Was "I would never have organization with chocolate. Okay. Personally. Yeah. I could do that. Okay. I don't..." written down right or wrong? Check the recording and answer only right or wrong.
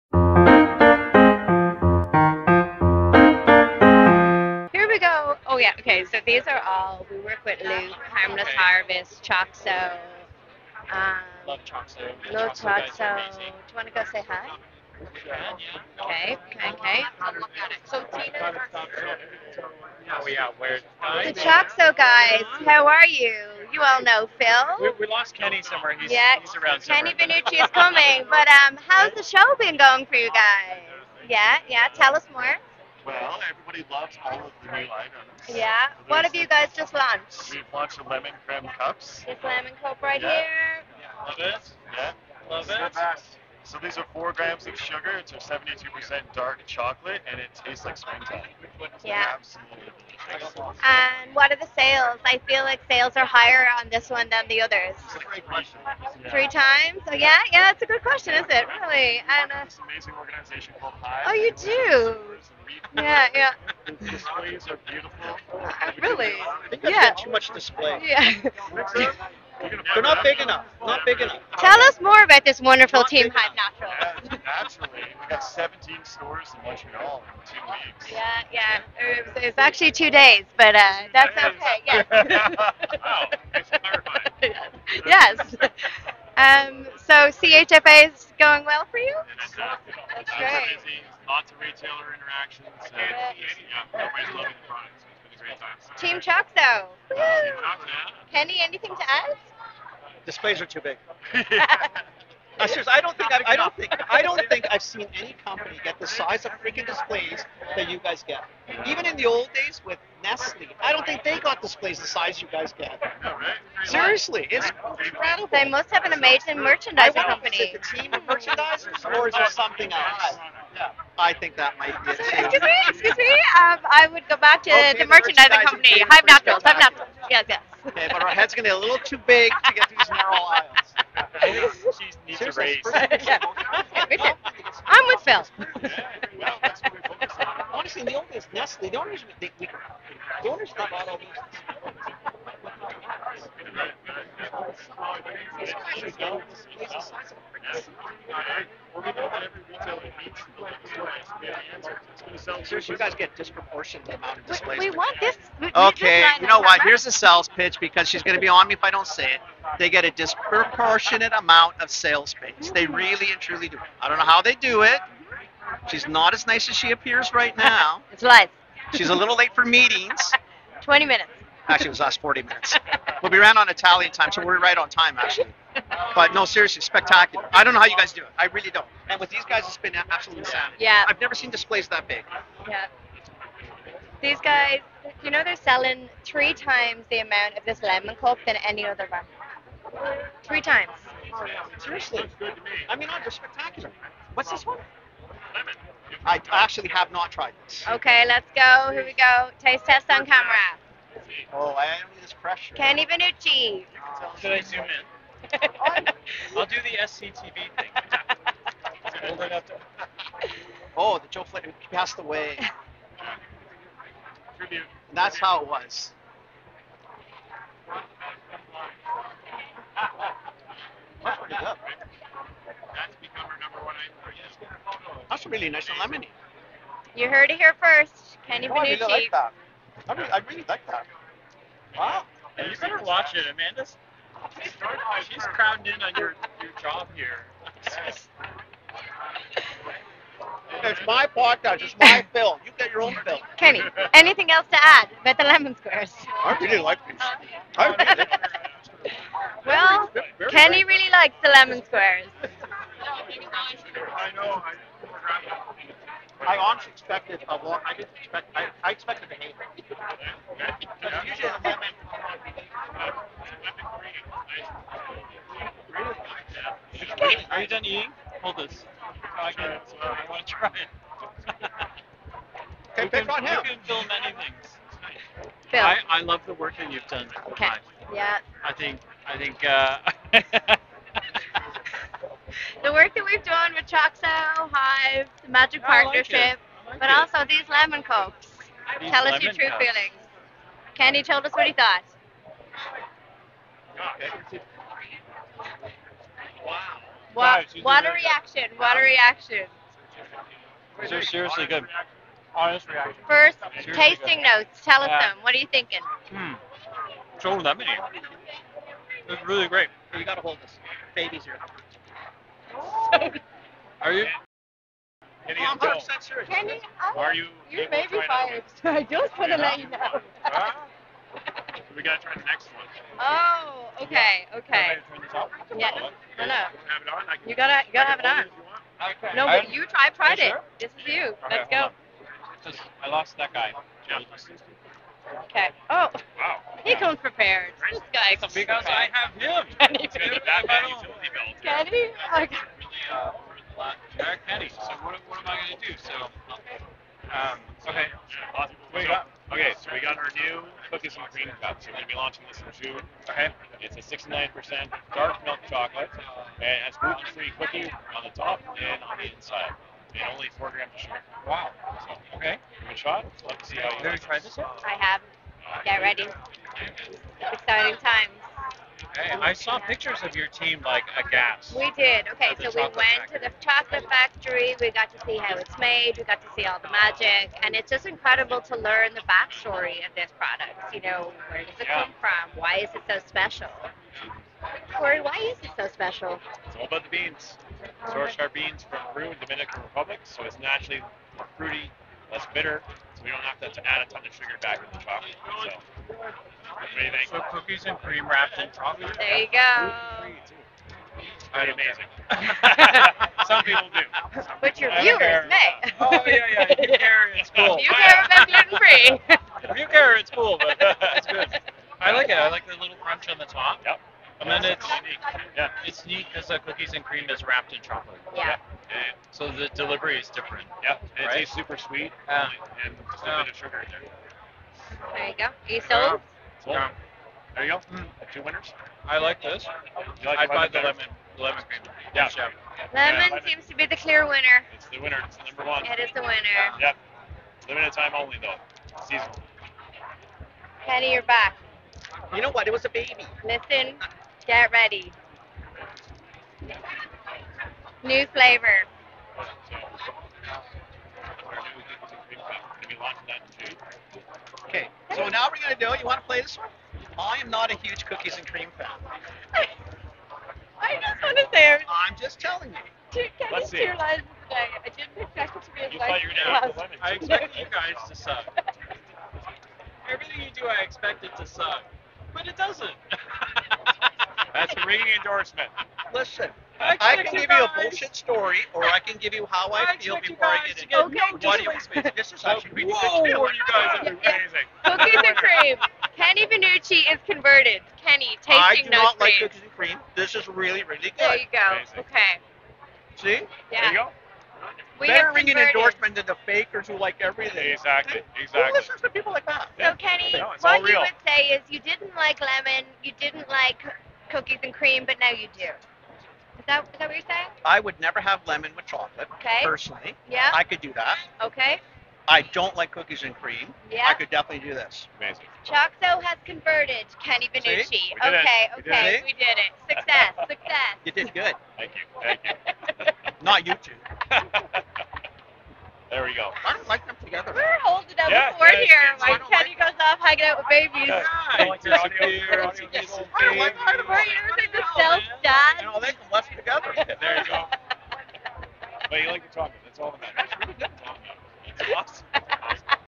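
wrong.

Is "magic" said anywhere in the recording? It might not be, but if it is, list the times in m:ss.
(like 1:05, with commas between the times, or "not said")
4:45, 6:16.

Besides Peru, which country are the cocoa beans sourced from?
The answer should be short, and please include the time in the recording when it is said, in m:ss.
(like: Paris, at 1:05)
Dominican Republic, at 6:29.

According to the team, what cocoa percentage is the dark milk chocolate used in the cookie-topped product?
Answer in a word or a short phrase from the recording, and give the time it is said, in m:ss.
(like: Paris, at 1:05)
69%, at 5:54.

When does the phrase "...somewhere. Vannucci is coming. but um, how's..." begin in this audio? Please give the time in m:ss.
0:27.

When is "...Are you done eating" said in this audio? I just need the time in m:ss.
4:27.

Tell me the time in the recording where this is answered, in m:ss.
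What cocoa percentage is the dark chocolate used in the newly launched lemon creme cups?
0:45.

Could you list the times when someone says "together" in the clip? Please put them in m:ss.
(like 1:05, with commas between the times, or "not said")
8:47, 8:56.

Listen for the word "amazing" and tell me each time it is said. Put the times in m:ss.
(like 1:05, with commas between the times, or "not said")
0:59, 1:56, 6:41, 8:04, 8:11, 8:35.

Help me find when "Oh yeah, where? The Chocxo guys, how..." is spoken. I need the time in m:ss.
0:20.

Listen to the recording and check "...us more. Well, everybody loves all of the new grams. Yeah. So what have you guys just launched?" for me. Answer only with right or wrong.
wrong.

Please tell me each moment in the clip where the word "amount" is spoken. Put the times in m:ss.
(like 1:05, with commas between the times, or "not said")
2:34, 2:41, 3:07.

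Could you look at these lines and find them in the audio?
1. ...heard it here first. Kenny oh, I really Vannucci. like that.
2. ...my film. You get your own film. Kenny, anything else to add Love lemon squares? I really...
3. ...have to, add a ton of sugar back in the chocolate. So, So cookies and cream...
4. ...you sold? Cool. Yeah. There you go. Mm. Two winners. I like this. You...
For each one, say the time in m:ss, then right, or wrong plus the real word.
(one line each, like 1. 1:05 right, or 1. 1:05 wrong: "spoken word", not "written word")
1. 3:47 right
2. 4:01 wrong: "Better", not "Love"
3. 6:33 right
4. 7:05 right.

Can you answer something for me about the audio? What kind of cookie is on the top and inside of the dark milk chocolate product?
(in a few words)
gluten-free cookie.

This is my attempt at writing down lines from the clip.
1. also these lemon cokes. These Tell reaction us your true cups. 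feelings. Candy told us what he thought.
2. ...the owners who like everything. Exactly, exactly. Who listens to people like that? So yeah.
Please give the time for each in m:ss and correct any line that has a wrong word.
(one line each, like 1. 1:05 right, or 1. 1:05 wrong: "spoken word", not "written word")
1. 4:47 wrong: "lemon", not "reaction"
2. 8:16 wrong: "fakers", not "owners".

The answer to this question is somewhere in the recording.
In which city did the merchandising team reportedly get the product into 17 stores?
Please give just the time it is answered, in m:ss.
1:16.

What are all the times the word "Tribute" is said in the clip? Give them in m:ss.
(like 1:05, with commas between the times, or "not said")
3:34.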